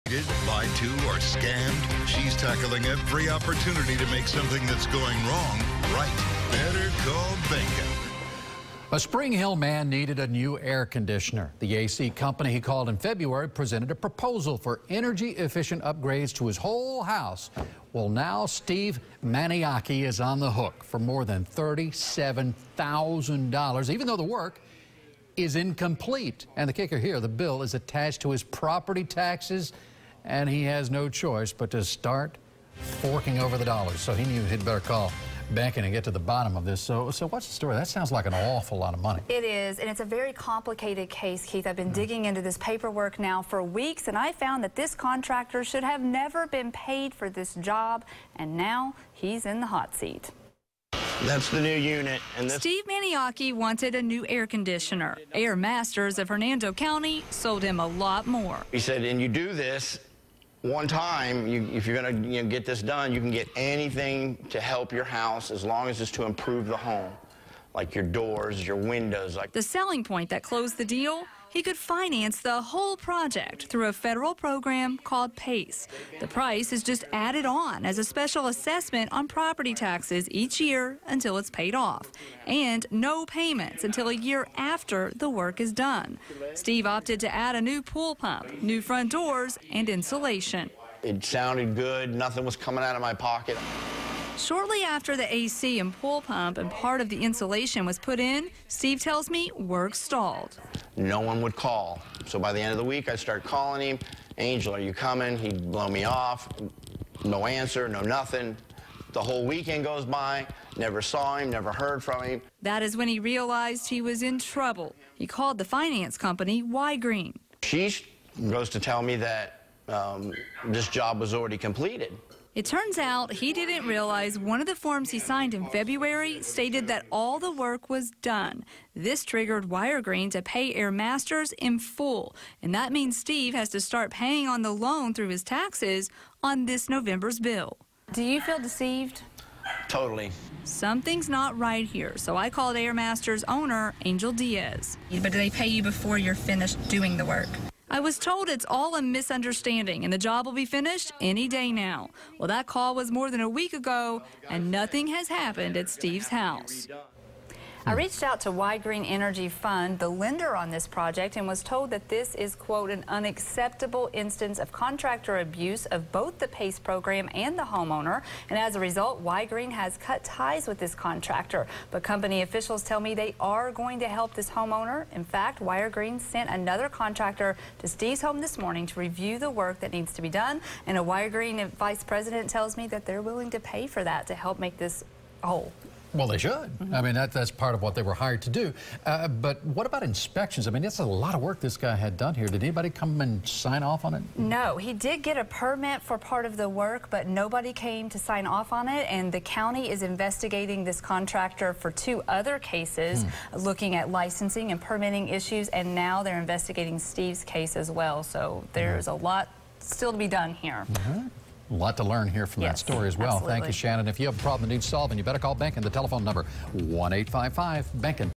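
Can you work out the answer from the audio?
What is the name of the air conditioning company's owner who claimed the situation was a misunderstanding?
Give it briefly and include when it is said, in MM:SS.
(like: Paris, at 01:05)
Angel Diaz, at 02:24.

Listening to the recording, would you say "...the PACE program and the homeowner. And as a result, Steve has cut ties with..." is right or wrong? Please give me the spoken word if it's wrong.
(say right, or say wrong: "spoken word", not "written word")
wrong: "Ygrene", not "Steve".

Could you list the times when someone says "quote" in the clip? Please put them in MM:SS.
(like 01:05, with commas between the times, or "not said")
02:42.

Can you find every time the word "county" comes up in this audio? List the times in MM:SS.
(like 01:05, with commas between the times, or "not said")
00:56, 03:19.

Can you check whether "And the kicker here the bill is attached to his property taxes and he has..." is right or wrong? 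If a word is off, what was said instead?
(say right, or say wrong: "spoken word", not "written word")
right.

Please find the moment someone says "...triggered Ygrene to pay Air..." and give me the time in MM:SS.
02:09.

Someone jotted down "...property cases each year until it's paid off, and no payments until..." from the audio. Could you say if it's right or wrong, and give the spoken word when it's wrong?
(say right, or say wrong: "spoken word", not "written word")
wrong: "taxes", not "cases".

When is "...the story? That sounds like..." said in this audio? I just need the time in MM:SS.
00:37.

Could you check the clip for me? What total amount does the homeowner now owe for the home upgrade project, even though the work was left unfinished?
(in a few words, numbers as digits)
$37,000.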